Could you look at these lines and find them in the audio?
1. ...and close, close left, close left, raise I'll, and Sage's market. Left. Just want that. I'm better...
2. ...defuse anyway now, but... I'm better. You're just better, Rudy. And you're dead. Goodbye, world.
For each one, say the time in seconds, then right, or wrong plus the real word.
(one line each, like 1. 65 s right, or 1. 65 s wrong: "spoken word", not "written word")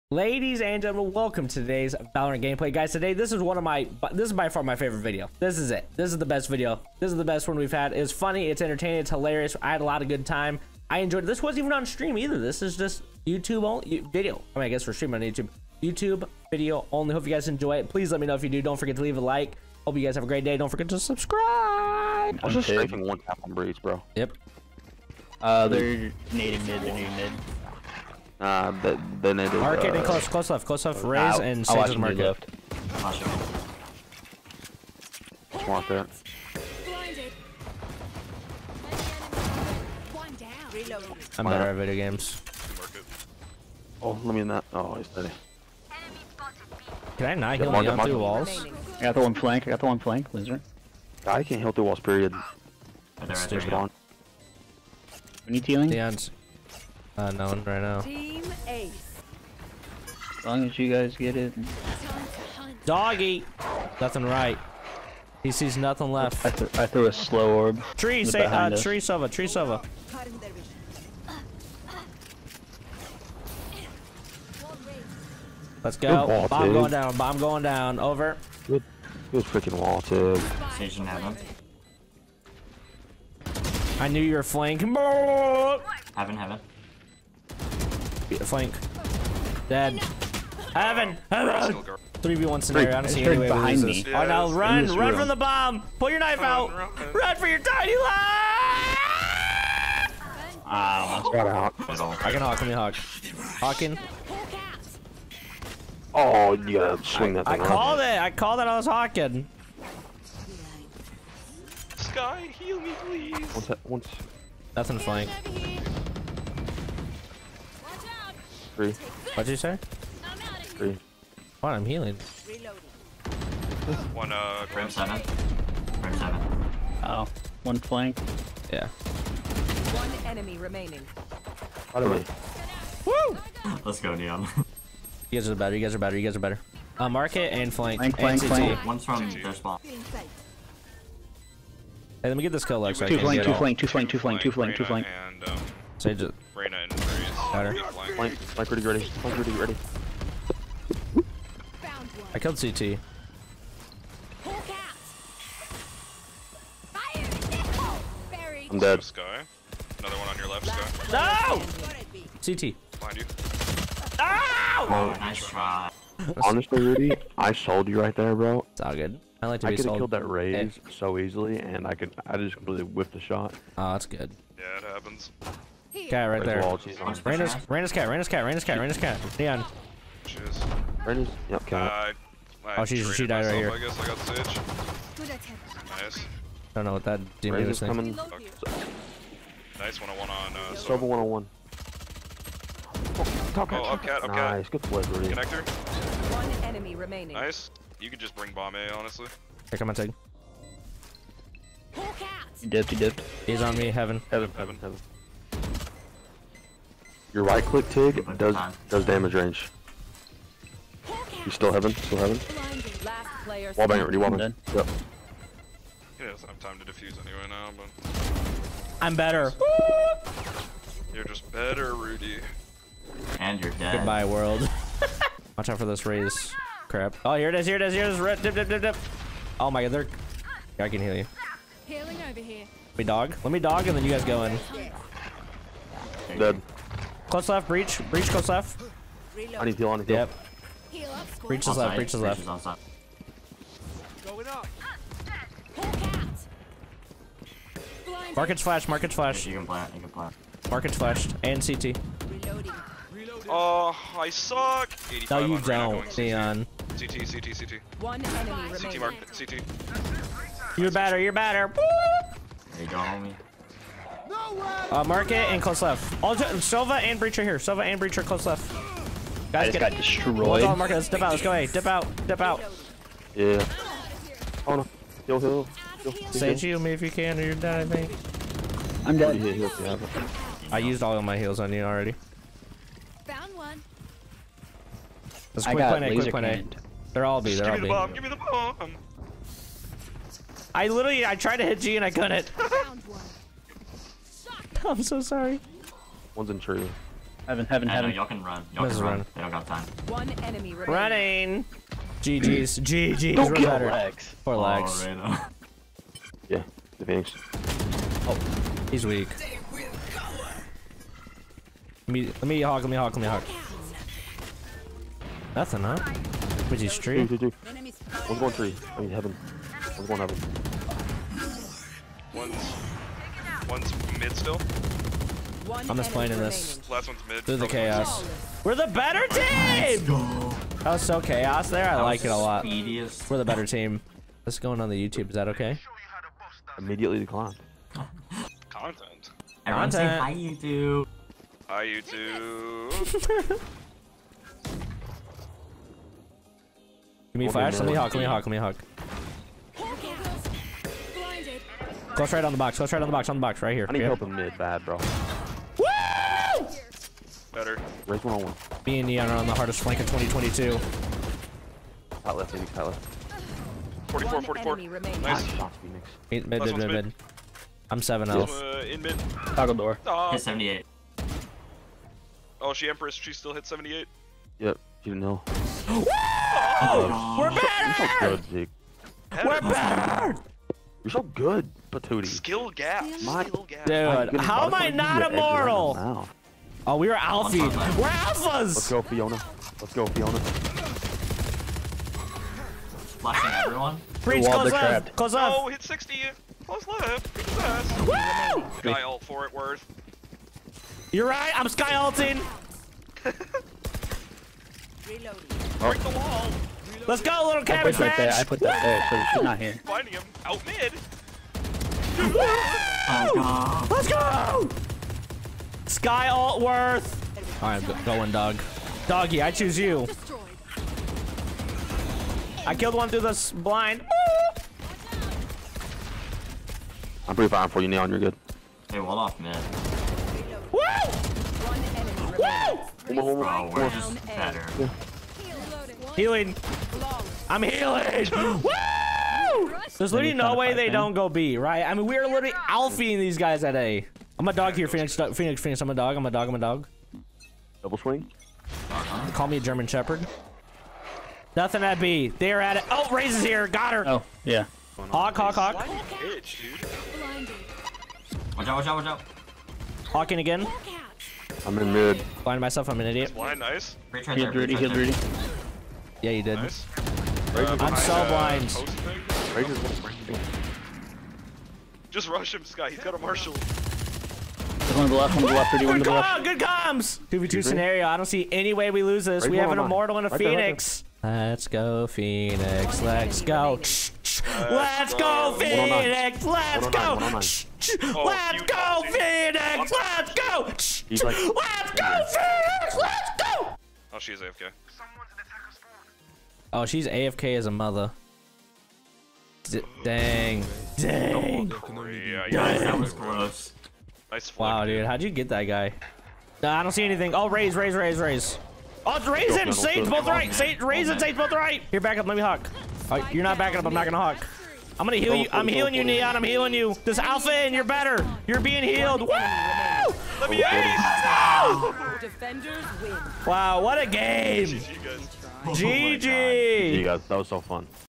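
1. 29 s right
2. 216 s right.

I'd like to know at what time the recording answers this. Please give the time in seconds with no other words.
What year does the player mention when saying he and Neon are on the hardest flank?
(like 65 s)
360 s.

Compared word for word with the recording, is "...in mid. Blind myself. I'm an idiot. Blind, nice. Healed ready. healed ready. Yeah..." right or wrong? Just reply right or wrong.
right.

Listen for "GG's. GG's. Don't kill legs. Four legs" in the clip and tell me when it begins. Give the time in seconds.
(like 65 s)
302 s.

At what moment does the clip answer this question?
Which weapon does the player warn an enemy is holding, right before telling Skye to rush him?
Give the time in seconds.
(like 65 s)
473 s.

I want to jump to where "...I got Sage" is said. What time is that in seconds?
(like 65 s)
184 s.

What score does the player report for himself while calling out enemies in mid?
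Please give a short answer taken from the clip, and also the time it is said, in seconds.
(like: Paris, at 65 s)
7 0, at 367 s.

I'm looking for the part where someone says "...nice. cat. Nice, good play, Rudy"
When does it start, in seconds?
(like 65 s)
194 s.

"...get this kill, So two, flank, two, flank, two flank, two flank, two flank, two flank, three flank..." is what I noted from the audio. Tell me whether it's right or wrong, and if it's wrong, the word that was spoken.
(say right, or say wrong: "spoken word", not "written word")
wrong: "two", not "three".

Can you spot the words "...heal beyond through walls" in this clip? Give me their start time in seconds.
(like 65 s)
47 s.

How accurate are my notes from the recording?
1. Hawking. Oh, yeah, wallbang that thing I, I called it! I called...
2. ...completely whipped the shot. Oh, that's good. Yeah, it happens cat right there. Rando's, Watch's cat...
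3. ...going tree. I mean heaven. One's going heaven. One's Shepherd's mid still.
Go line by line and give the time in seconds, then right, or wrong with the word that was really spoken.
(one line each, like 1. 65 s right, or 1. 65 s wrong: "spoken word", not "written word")
1. 103 s wrong: "swing", not "wallbang"
2. 172 s wrong: "Rando", not "Watch"
3. 318 s wrong: "One", not "Shepherd".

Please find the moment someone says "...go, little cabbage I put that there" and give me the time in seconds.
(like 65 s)
407 s.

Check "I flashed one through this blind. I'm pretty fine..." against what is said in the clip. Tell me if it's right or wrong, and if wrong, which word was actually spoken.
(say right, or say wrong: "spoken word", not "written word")
wrong: "killed", not "flashed".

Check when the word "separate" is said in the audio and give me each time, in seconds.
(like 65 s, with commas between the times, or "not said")
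not said.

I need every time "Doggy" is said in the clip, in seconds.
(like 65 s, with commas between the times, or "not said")
62 s, 419 s.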